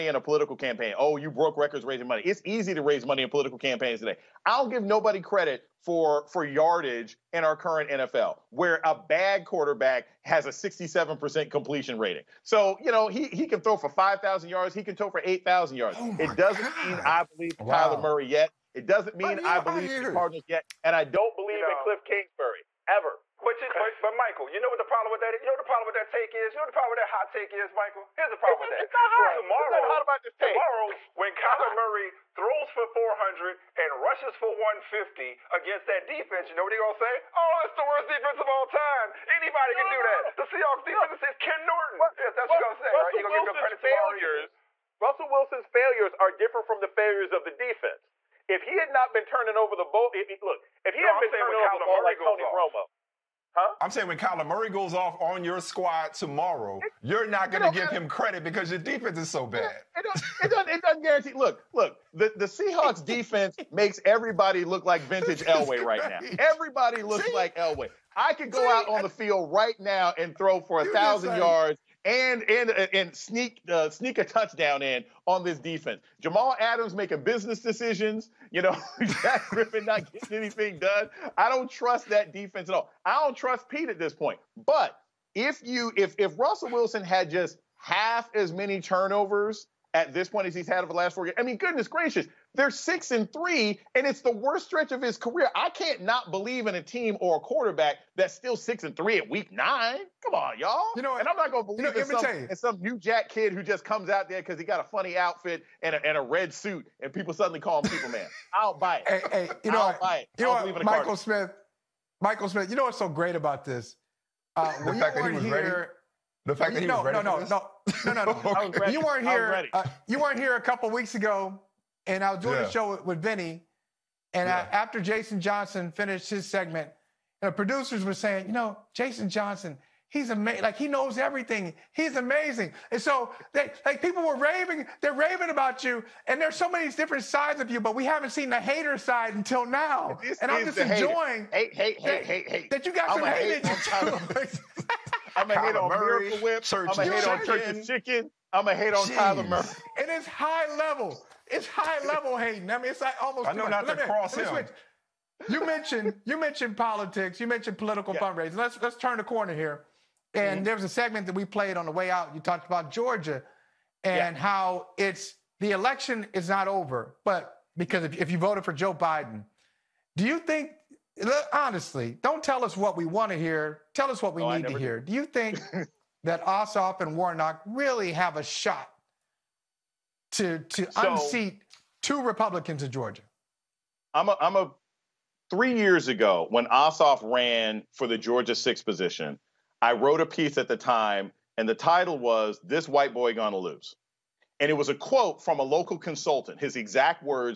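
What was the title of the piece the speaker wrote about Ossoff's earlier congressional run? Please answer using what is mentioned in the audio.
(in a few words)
This White Boy Gonna Lose.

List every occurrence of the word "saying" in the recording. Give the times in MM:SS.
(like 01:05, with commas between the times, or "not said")
00:53, 02:08.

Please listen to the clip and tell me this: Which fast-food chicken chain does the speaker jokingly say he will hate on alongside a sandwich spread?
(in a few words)
Church's Chicken.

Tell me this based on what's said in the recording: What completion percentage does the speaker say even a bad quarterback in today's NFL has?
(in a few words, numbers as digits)
67%.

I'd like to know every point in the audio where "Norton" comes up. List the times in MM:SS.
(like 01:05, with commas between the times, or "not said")
00:41.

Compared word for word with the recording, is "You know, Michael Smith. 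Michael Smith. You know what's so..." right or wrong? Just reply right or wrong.
right.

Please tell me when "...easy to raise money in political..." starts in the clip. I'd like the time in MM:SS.
00:02.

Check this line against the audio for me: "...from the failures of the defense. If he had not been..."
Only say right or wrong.
right.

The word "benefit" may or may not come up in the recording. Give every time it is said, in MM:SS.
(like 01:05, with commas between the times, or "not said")
not said.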